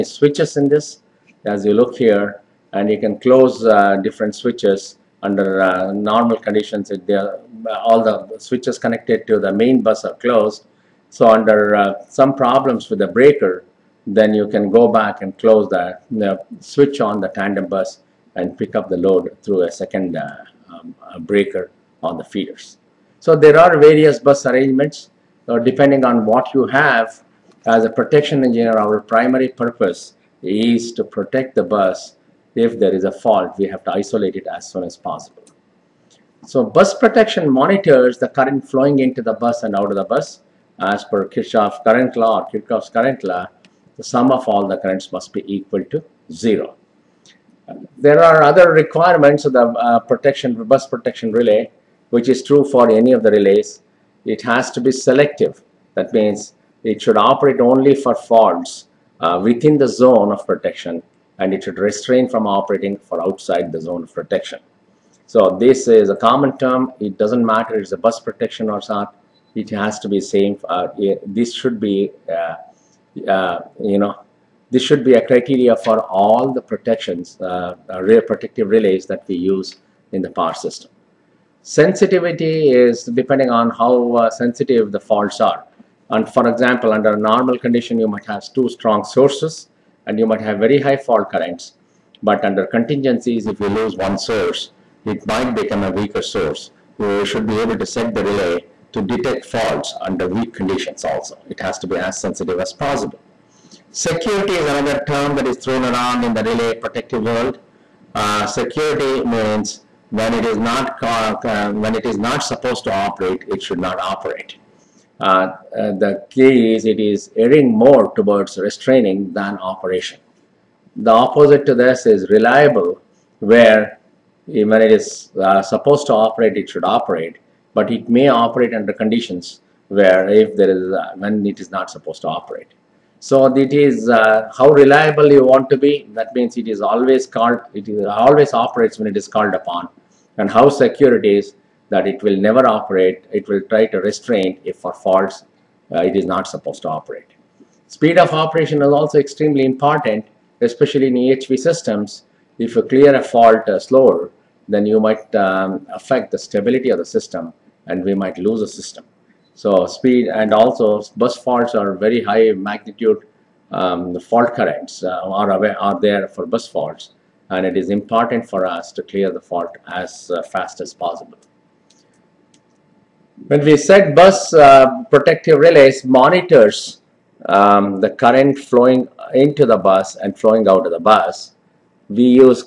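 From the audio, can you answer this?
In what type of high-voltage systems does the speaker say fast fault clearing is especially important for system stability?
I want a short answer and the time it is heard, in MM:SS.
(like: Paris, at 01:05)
EHV systems, at 02:31.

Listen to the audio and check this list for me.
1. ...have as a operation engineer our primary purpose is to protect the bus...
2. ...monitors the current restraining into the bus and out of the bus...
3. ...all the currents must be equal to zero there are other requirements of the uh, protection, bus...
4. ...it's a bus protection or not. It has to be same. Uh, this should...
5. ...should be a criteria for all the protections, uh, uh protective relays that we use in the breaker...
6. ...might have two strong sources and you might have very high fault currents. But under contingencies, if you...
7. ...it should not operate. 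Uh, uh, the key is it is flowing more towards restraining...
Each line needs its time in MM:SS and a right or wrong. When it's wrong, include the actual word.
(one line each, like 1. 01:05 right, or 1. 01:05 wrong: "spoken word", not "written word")
1. 00:26 wrong: "protection", not "operation"
2. 00:37 wrong: "flowing", not "restraining"
3. 00:44 right
4. 01:07 right
5. 01:14 wrong: "power", not "breaker"
6. 01:28 right
7. 01:53 wrong: "erring", not "flowing".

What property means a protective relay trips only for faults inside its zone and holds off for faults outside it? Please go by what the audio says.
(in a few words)
Selective.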